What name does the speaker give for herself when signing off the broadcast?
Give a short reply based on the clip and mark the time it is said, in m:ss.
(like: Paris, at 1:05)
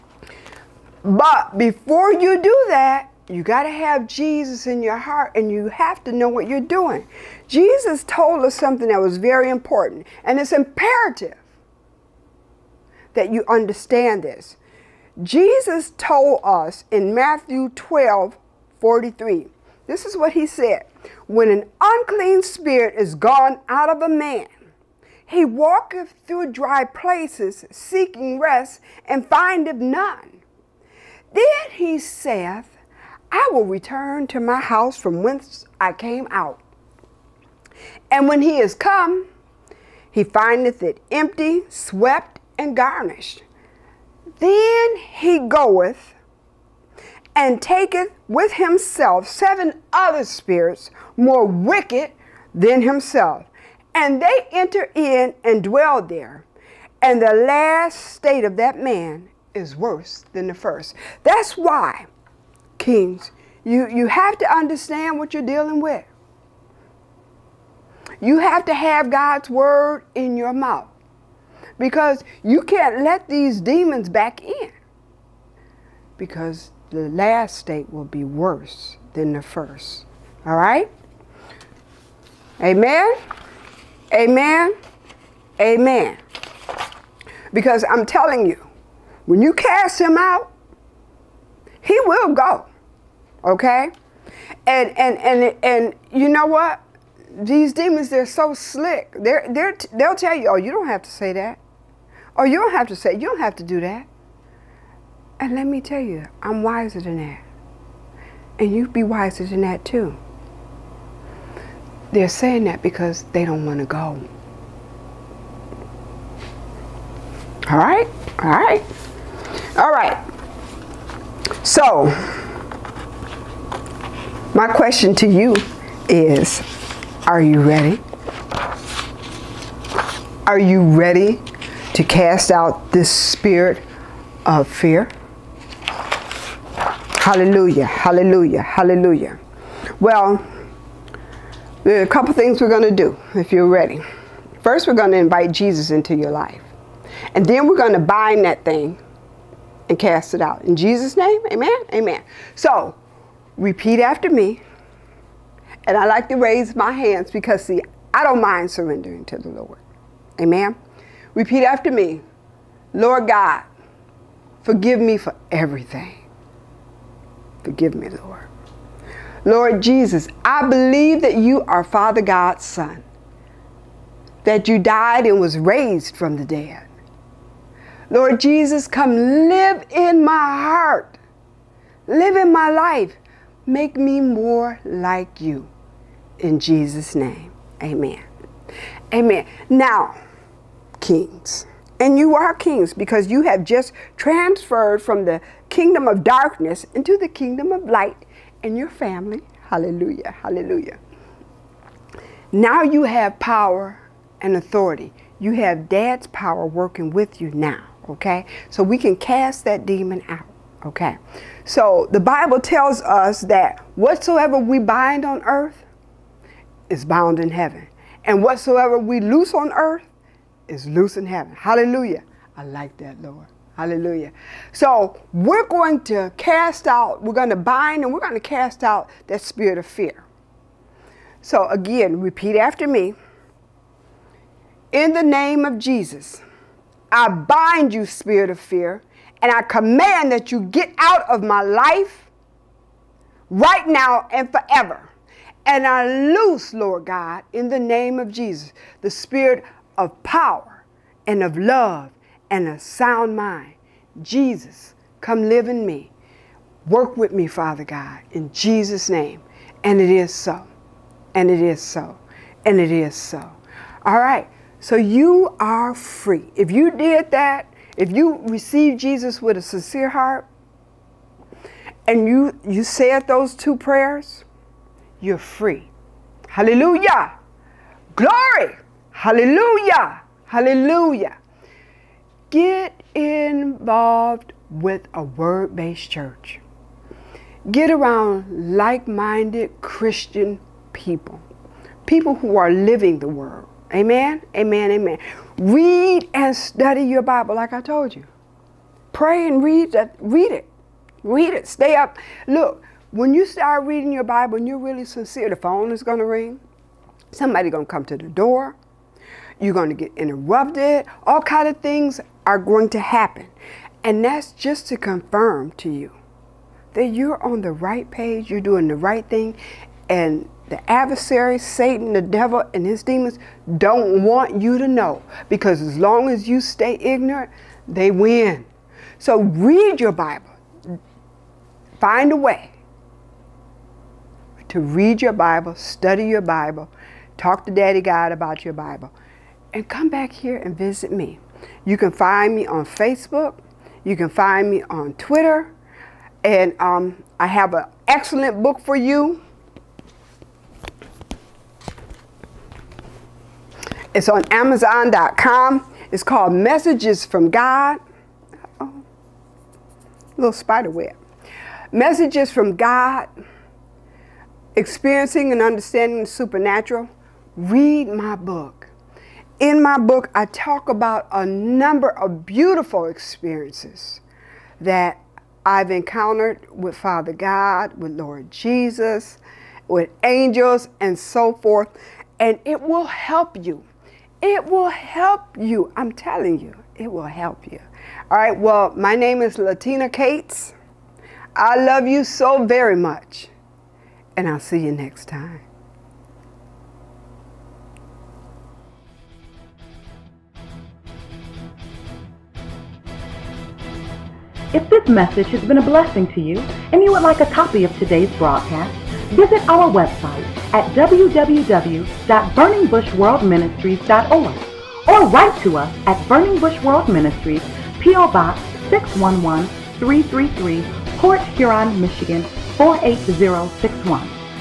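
Latina Cates, at 6:29.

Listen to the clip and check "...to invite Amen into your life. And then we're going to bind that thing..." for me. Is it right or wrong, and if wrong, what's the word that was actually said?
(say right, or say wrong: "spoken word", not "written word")
wrong: "Jesus", not "Amen".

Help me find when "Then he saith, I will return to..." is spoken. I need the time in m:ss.
0:31.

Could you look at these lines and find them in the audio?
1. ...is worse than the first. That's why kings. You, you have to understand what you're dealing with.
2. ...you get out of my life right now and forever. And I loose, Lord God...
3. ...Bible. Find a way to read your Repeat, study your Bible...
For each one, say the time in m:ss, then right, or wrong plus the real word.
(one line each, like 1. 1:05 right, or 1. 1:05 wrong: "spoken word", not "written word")
1. 0:59 right
2. 4:00 right
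3. 5:30 wrong: "Bible", not "Repeat".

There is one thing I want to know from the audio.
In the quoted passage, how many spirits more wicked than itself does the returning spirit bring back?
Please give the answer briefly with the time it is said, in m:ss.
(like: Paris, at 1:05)
7, at 0:49.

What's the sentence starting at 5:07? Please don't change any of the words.
Somebody's going to come to the door.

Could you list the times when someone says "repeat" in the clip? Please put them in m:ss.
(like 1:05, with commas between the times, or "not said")
2:33, 2:41, 3:52.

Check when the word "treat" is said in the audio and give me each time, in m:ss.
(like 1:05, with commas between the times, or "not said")
not said.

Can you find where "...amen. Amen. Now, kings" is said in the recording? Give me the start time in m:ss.
3:07.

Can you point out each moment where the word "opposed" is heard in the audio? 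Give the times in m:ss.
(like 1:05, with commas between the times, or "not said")
not said.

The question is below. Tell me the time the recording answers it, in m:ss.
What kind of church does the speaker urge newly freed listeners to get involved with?
4:45.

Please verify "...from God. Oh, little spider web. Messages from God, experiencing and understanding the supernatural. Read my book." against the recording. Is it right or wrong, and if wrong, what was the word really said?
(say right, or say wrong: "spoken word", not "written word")
right.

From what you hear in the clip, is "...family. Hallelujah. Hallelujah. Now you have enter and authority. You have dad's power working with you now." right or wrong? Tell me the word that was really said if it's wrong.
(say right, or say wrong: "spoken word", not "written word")
wrong: "power", not "enter".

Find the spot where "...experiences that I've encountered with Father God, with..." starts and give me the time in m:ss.
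6:13.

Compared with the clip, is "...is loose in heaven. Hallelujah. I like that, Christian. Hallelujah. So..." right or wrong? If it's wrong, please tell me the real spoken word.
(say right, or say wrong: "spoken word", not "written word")
wrong: "Lord", not "Christian".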